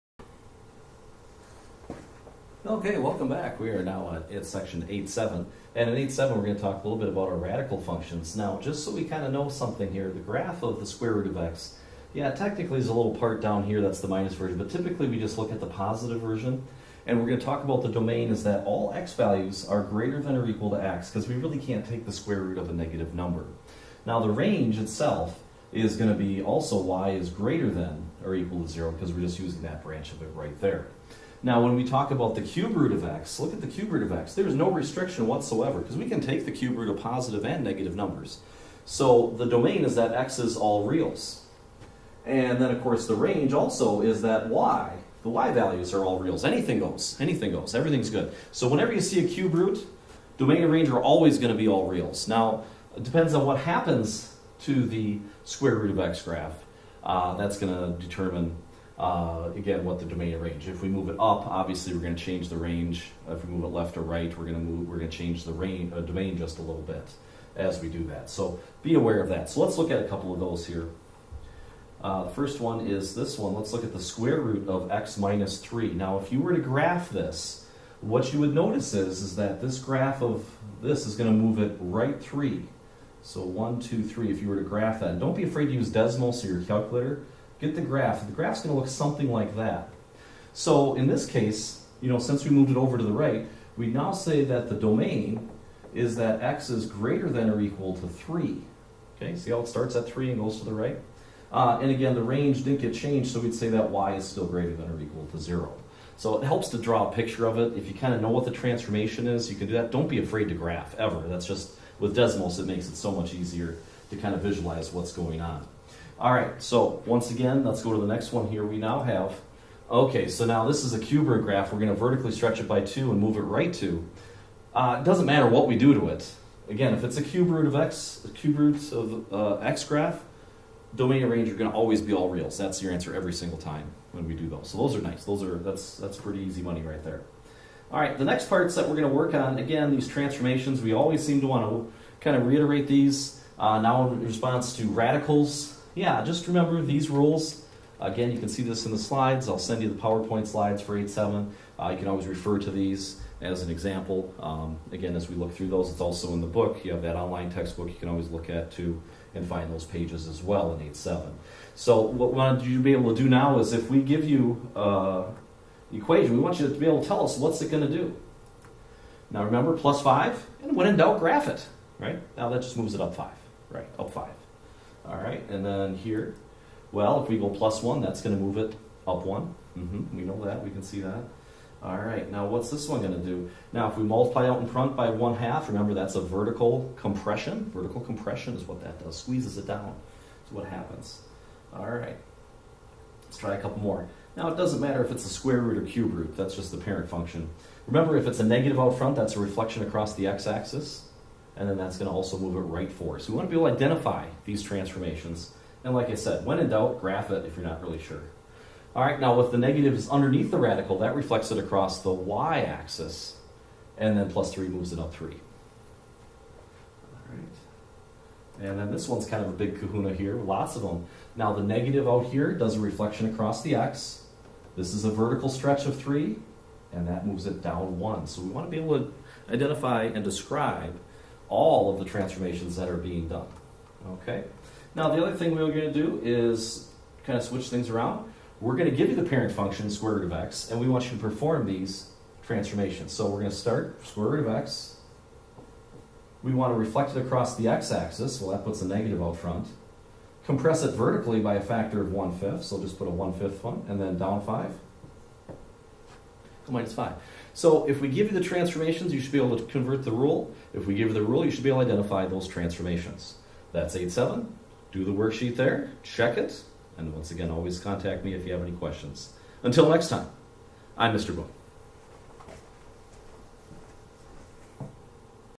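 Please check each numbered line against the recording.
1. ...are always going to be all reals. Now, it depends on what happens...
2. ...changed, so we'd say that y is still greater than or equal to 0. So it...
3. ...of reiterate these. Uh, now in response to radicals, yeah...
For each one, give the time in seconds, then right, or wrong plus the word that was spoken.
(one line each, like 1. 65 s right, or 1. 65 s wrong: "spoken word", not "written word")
1. 50 s right
2. 102 s right
3. 142 s right.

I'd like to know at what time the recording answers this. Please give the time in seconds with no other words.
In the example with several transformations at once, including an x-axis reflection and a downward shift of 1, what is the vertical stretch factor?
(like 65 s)
225 s.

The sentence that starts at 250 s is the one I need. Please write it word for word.
Compress it vertically by a factor of 1 fifth, so just put a 1 fifth one, and then down 5 minus 5.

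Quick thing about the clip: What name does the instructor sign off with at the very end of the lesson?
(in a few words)
Mr. Boone.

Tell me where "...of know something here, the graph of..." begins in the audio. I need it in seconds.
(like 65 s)
9 s.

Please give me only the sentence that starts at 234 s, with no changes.
Now, the other thing we are going to do is kind of switch things around.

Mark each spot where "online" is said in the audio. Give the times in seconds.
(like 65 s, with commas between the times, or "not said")
157 s.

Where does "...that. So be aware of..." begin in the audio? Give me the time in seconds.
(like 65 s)
68 s.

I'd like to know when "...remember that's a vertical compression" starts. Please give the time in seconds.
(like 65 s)
185 s.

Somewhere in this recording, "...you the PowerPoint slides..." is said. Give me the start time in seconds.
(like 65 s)
149 s.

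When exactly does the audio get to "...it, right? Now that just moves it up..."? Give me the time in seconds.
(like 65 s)
171 s.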